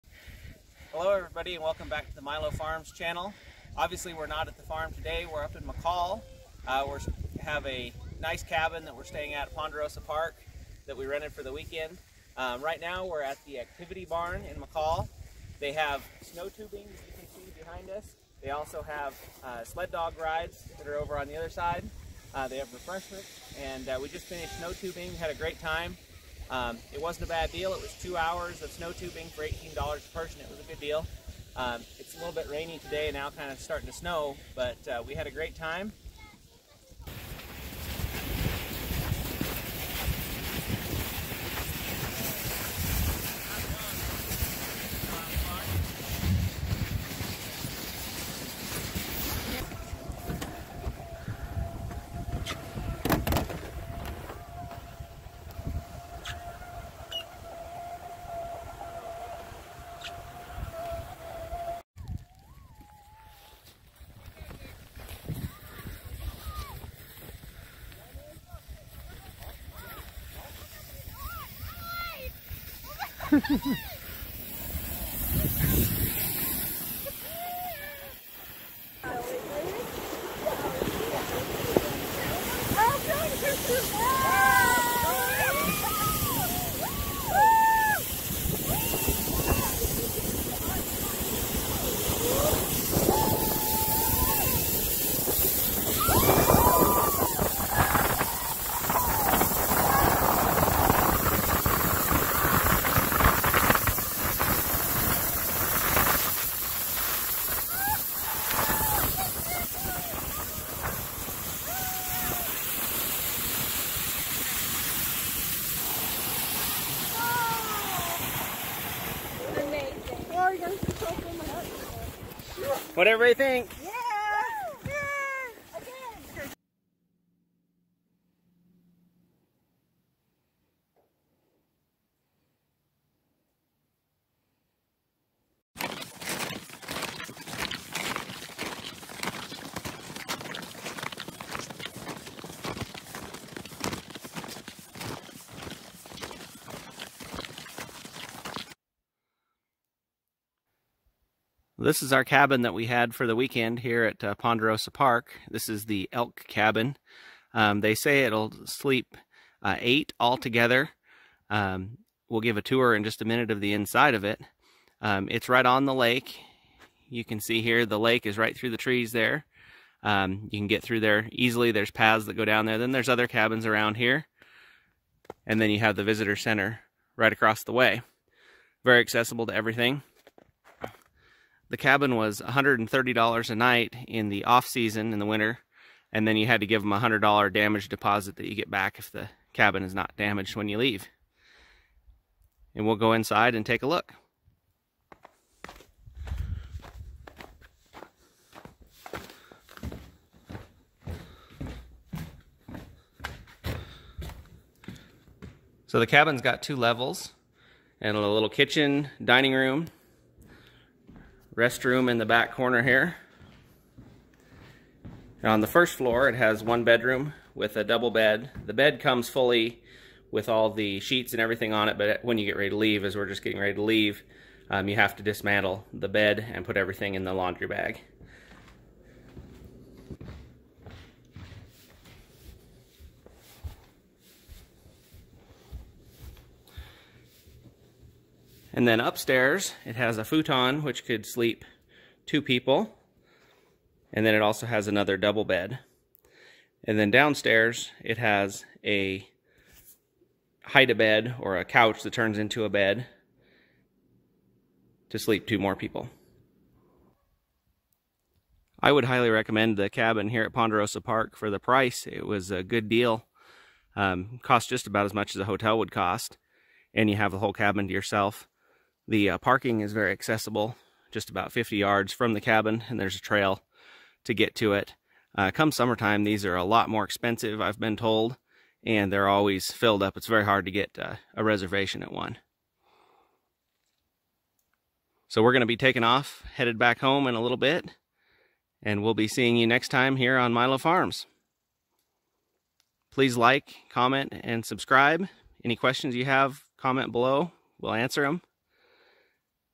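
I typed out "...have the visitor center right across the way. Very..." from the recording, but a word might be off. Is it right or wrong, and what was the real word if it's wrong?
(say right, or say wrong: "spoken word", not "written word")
right.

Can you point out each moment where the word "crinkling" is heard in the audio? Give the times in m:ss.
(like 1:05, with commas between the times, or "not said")
not said.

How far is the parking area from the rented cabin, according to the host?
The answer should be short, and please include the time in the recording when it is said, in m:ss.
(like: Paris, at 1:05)
50 yards, at 4:31.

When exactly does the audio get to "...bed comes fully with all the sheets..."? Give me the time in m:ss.
3:38.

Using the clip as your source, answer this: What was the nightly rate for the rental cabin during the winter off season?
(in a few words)
$130.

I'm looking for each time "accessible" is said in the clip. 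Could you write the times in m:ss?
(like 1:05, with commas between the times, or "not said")
2:58, 4:30.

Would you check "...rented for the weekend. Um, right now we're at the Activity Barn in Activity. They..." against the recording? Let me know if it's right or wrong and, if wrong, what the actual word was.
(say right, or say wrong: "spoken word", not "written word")
wrong: "McCall", not "Activity".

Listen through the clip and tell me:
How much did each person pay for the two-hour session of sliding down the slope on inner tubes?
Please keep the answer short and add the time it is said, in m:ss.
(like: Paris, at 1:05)
$18, at 0:29.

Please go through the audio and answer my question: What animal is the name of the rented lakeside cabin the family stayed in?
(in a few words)
Elk.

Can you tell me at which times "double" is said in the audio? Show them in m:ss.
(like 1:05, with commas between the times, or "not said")
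3:37, 4:05.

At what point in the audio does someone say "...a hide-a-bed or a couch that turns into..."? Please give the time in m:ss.
4:08.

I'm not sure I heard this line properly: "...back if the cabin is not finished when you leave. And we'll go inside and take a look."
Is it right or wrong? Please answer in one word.
wrong.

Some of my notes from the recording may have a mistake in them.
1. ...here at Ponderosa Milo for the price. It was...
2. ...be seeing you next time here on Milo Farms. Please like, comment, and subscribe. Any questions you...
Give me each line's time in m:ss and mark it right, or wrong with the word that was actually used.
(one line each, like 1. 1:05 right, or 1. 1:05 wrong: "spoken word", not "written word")
1. 4:20 wrong: "Park", not "Milo"
2. 4:49 right.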